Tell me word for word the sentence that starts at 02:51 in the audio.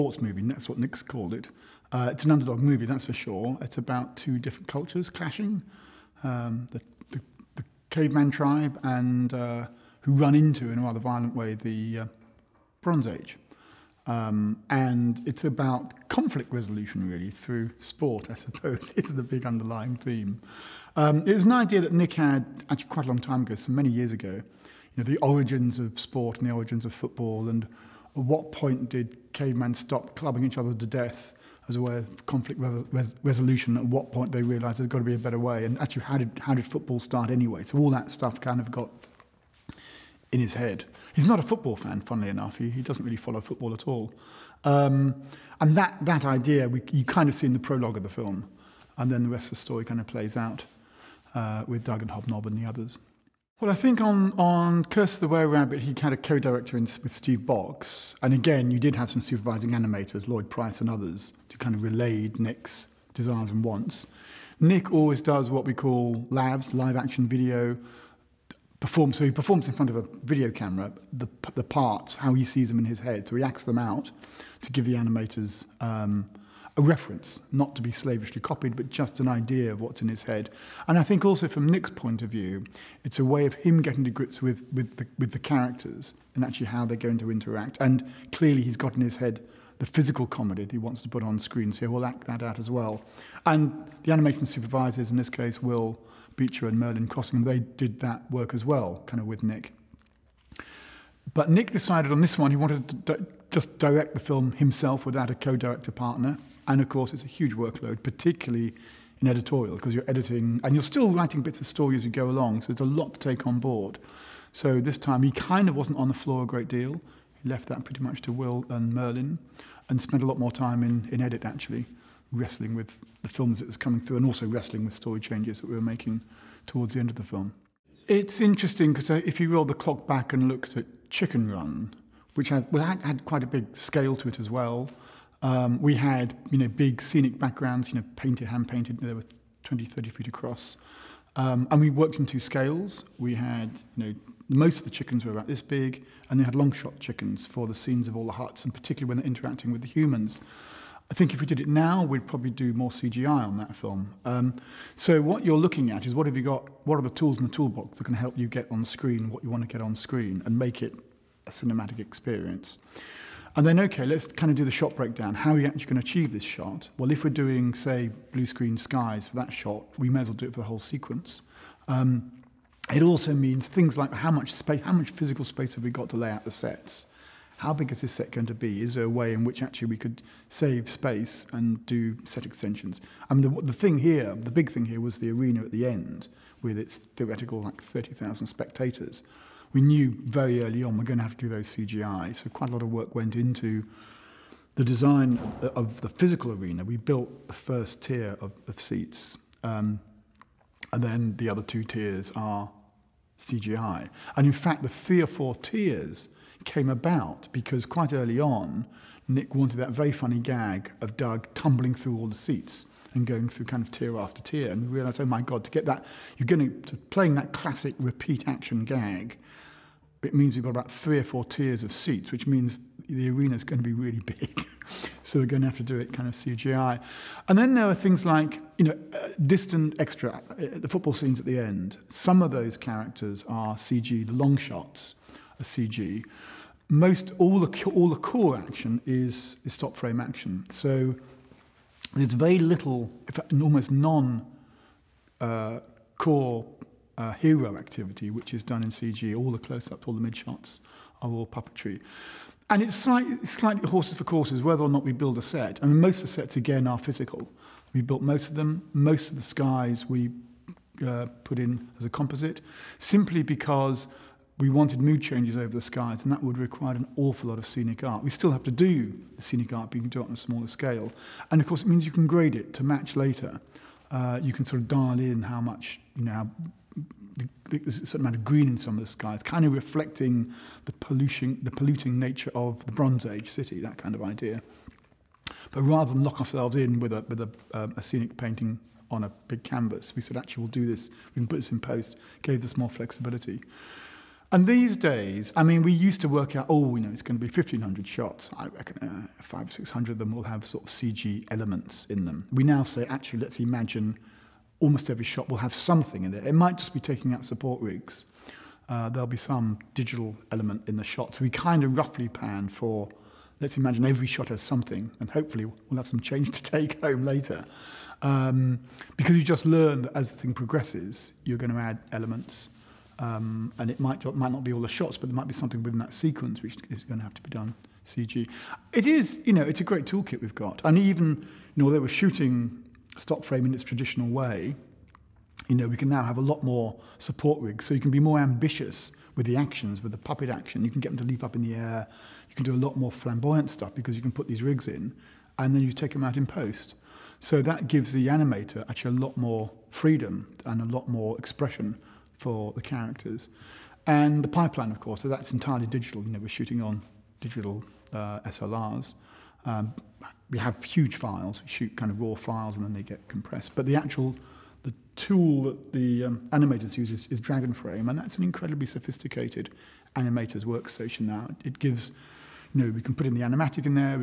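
Um, it also means things like how much space, how much physical space have we got to lay out the sets?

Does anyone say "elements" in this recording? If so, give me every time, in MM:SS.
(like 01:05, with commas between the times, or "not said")
05:01, 05:10, 05:22.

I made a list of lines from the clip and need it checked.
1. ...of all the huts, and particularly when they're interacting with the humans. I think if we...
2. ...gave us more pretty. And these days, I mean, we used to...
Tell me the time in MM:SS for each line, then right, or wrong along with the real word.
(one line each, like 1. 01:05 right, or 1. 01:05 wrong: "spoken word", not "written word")
1. 02:28 right
2. 04:52 wrong: "flexibility", not "pretty".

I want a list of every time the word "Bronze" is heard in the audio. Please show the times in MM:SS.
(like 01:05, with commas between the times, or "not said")
00:12, 04:42.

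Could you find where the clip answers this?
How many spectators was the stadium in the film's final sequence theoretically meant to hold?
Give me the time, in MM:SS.
03:07.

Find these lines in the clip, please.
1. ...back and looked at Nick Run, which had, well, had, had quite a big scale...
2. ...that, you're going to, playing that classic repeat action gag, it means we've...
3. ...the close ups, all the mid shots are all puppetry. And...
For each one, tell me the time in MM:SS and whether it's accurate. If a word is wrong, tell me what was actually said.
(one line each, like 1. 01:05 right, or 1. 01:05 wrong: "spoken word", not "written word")
1. 02:10 wrong: "Chicken", not "Nick"
2. 03:35 right
3. 04:09 right.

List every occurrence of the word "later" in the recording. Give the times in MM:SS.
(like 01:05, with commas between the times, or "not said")
04:33, 05:17.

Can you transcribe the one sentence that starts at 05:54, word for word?
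And the pipeline, of course, so that's entirely digital.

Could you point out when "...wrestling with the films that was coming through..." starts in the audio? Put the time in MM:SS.
02:02.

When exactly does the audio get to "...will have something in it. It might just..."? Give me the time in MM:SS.
05:05.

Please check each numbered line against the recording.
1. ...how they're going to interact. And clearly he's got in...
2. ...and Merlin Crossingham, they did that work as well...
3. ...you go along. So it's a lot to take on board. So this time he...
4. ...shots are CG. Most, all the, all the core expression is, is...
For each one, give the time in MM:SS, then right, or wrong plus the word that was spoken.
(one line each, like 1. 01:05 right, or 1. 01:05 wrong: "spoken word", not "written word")
1. 01:26 right
2. 01:36 right
3. 01:52 right
4. 03:54 wrong: "action", not "expression".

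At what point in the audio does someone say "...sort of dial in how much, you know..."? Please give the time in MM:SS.
04:34.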